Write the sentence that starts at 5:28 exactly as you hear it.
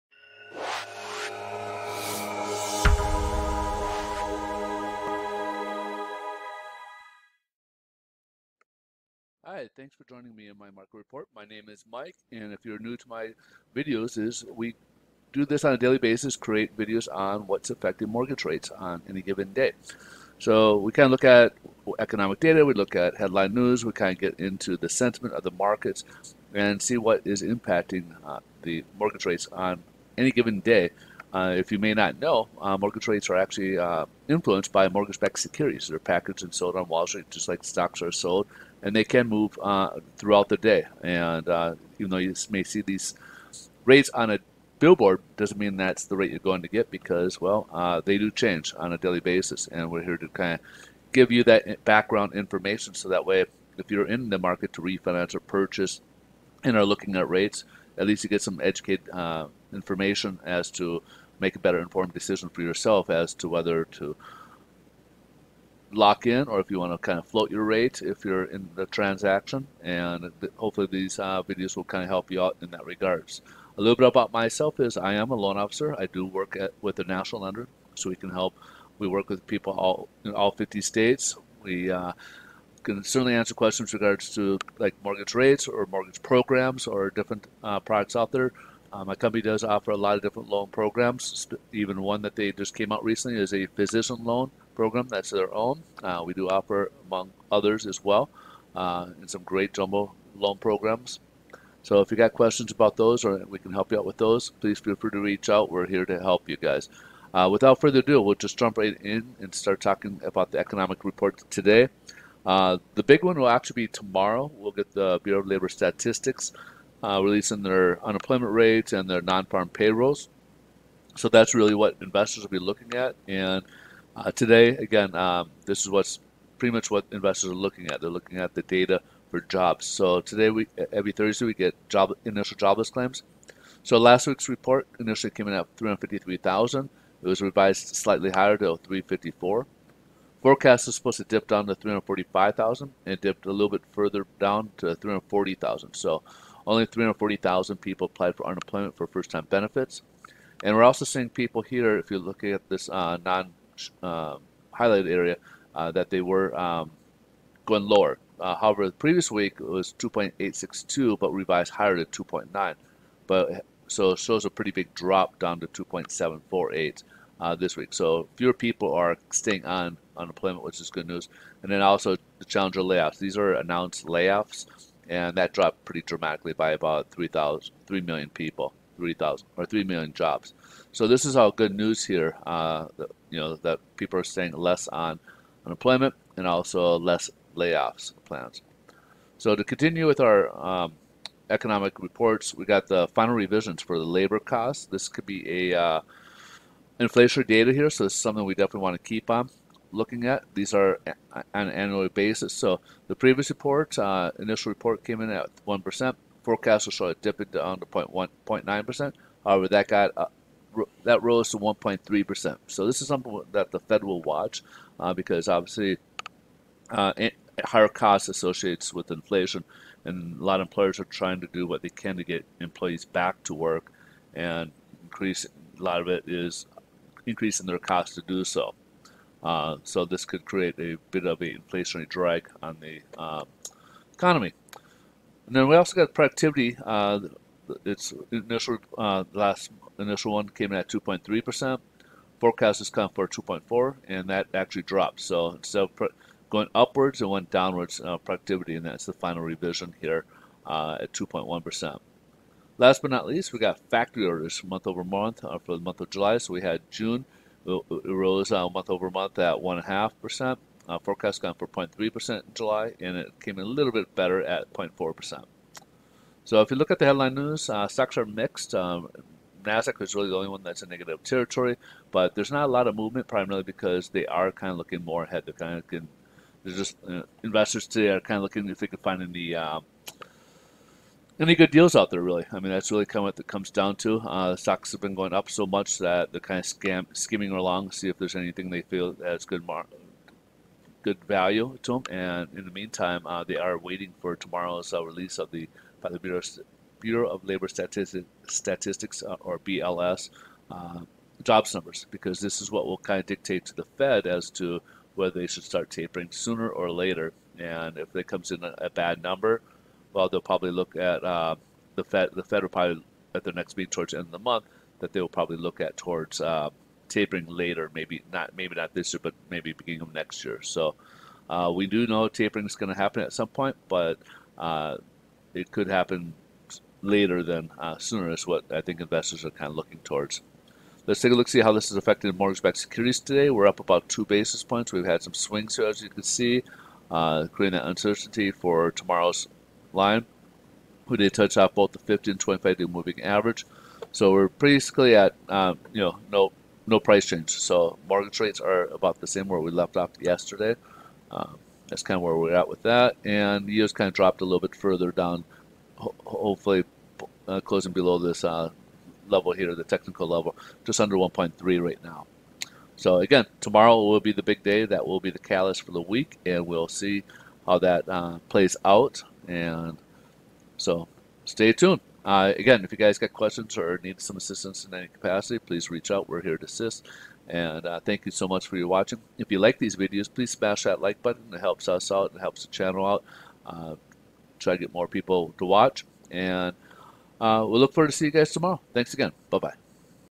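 Is what I think investors are kind of looking towards.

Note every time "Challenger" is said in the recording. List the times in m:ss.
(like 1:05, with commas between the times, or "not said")
2:52.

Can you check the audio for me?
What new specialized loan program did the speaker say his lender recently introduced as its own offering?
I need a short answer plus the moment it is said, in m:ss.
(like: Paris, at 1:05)
physician loan program, at 1:33.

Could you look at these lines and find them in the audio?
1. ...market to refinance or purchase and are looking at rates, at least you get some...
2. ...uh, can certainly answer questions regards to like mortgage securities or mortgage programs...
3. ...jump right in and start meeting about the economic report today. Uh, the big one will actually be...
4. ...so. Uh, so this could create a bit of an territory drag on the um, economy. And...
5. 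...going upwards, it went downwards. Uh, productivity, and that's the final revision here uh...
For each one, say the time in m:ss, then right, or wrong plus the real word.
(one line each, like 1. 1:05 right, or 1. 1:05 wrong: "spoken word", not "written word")
1. 0:54 right
2. 1:21 wrong: "rates", not "securities"
3. 1:48 wrong: "talking", not "meeting"
4. 3:48 wrong: "inflationary", not "territory"
5. 4:06 right.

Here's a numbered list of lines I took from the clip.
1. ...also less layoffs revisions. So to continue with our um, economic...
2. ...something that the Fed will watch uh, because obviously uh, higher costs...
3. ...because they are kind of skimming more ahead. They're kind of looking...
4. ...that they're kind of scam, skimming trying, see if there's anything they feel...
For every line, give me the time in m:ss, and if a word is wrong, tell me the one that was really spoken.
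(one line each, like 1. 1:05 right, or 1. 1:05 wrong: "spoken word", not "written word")
1. 3:06 wrong: "plans", not "revisions"
2. 3:33 right
3. 4:33 wrong: "looking", not "skimming"
4. 4:45 wrong: "along", not "trying".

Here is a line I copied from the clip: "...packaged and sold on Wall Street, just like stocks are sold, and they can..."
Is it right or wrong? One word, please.
right.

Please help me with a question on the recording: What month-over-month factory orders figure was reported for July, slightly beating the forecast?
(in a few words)
0.4%.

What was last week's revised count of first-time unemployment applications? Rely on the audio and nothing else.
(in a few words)
354,000.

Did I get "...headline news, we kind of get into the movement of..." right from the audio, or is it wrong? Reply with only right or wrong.
wrong.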